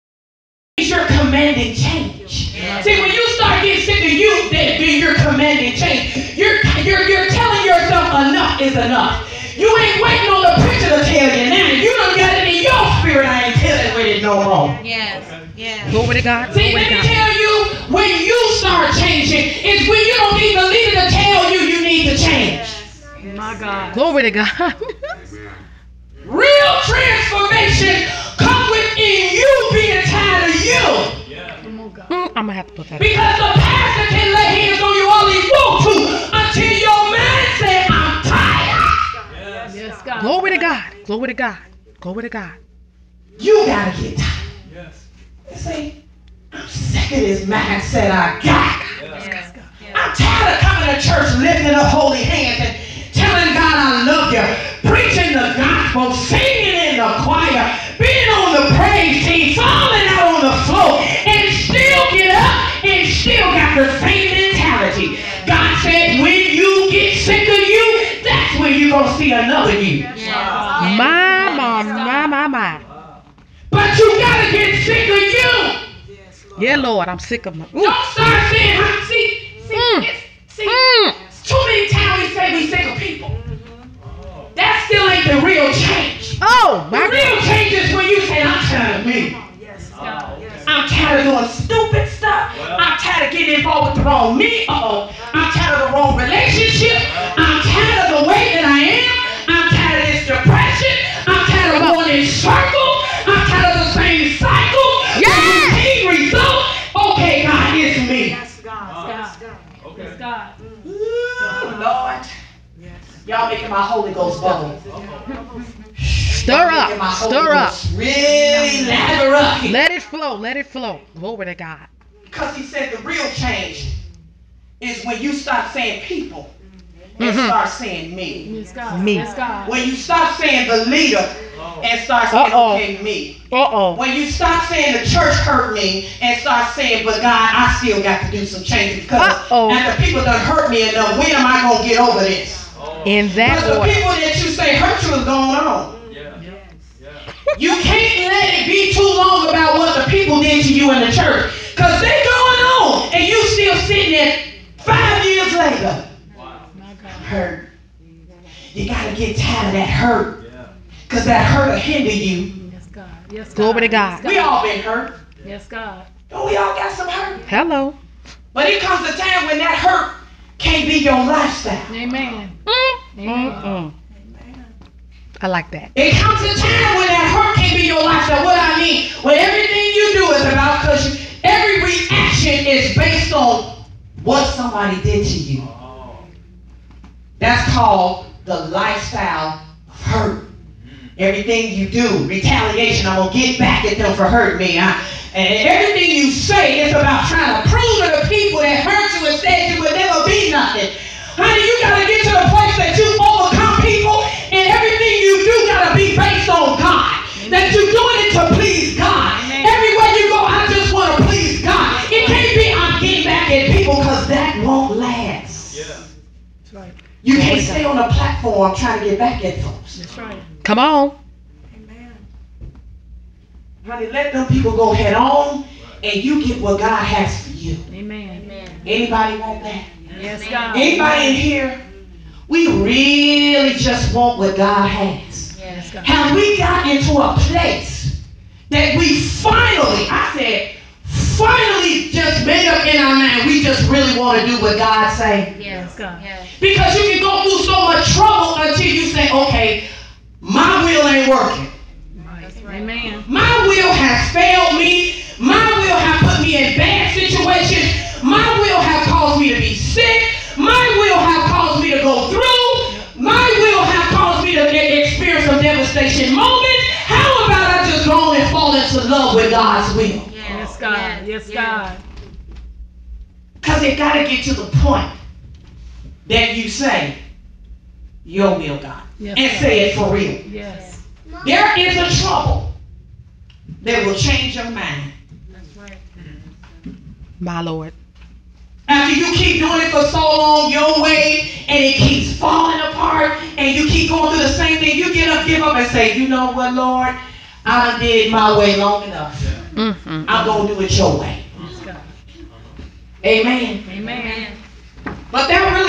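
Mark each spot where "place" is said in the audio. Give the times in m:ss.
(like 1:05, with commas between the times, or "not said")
3:22, 3:57.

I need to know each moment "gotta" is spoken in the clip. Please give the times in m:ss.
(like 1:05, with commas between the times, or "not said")
0:43.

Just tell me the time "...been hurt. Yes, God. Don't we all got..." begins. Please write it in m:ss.
2:44.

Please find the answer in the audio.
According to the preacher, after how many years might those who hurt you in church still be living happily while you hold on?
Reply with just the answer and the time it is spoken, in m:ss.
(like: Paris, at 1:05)
5, at 2:34.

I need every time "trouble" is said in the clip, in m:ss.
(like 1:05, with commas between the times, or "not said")
4:08, 4:42.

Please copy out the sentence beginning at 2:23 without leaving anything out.
In that Because the people that you say hurt you is going on.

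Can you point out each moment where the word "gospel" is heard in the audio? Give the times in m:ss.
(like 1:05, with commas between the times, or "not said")
0:55.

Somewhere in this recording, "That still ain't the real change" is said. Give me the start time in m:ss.
1:24.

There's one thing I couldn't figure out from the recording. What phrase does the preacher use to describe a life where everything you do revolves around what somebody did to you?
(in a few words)
lifestyle of hurt.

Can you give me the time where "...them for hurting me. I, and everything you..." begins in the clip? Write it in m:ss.
3:13.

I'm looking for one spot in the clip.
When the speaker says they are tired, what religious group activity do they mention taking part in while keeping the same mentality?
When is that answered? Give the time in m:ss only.
0:56.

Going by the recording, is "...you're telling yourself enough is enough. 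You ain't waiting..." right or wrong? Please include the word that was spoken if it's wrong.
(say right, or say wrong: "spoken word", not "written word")
right.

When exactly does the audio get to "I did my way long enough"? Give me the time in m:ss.
4:57.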